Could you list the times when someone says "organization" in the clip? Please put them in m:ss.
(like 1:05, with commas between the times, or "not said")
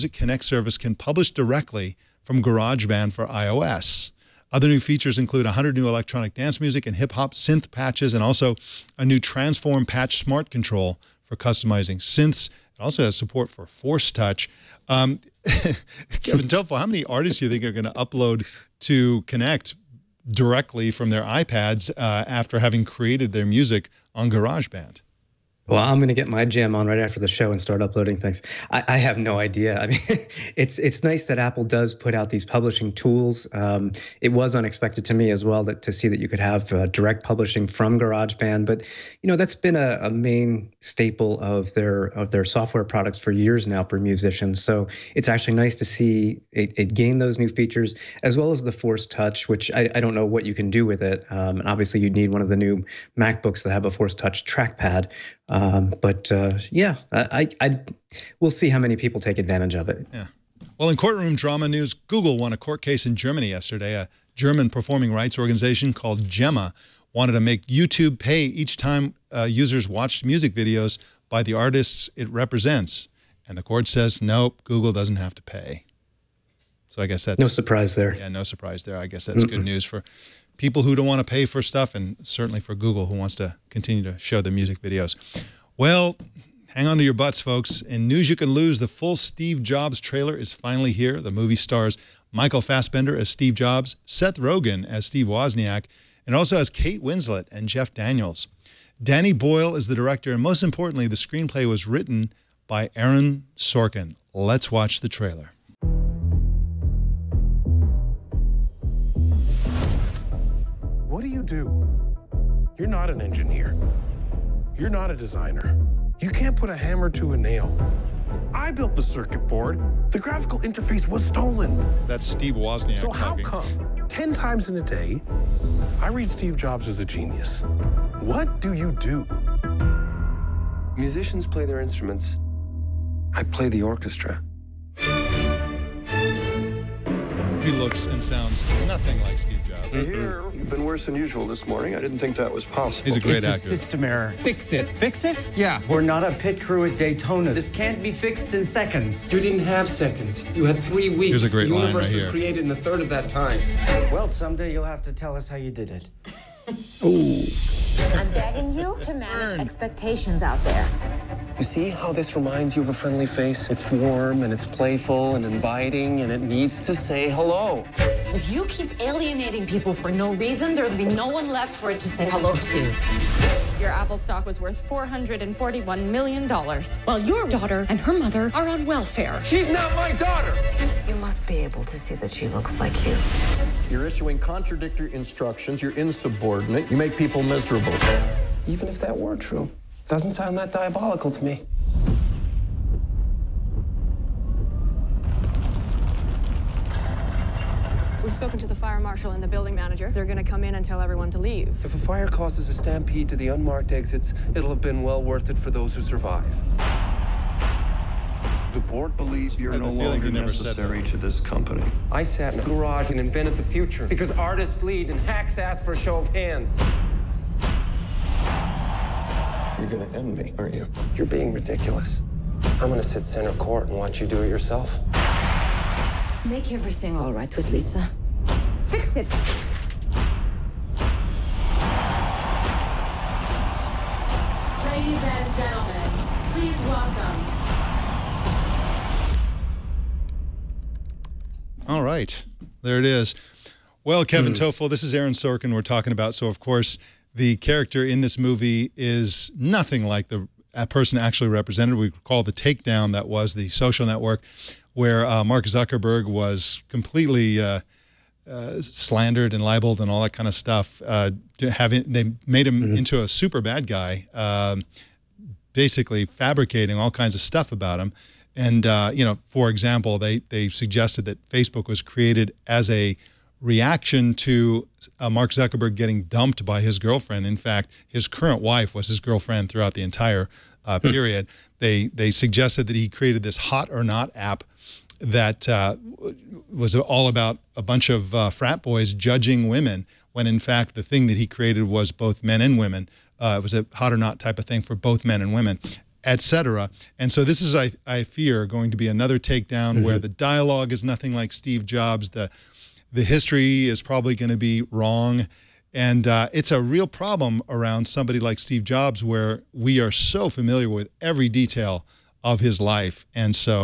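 1:05.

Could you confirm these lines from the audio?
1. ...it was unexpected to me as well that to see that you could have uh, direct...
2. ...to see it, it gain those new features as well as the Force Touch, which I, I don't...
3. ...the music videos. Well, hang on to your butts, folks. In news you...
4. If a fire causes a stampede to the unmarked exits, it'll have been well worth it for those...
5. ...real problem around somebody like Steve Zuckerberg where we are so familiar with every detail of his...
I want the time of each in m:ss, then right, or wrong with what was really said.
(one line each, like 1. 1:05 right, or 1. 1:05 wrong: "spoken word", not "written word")
1. 0:34 right
2. 0:45 right
3. 1:24 right
4. 3:21 right
5. 5:06 wrong: "Jobs", not "Zuckerberg".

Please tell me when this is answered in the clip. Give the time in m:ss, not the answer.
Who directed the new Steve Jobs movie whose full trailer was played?
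1:39.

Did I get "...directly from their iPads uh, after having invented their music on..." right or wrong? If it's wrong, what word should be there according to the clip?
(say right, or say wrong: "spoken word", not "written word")
wrong: "created", not "invented".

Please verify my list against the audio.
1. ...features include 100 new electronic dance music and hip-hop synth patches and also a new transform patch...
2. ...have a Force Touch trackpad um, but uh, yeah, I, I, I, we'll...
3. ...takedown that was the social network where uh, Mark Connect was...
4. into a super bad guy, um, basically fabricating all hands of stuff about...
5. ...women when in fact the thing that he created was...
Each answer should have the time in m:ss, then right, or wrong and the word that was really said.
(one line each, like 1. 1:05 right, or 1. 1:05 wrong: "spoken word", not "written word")
1. 0:04 right
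2. 0:53 right
3. 4:12 wrong: "Zuckerberg", not "Connect"
4. 4:22 wrong: "kinds", not "hands"
5. 4:49 right.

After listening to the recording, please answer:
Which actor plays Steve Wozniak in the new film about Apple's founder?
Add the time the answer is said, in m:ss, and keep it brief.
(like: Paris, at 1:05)
Seth Rogen, at 1:34.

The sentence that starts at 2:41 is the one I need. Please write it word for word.
You see how this reminds you of a friendly face?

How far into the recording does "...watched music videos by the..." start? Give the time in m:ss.
1:09.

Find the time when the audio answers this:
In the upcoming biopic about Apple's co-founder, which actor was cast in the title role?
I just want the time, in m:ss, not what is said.
1:32.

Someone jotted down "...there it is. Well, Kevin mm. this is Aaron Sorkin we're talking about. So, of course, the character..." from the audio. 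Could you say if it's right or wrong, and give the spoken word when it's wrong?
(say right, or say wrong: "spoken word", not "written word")
right.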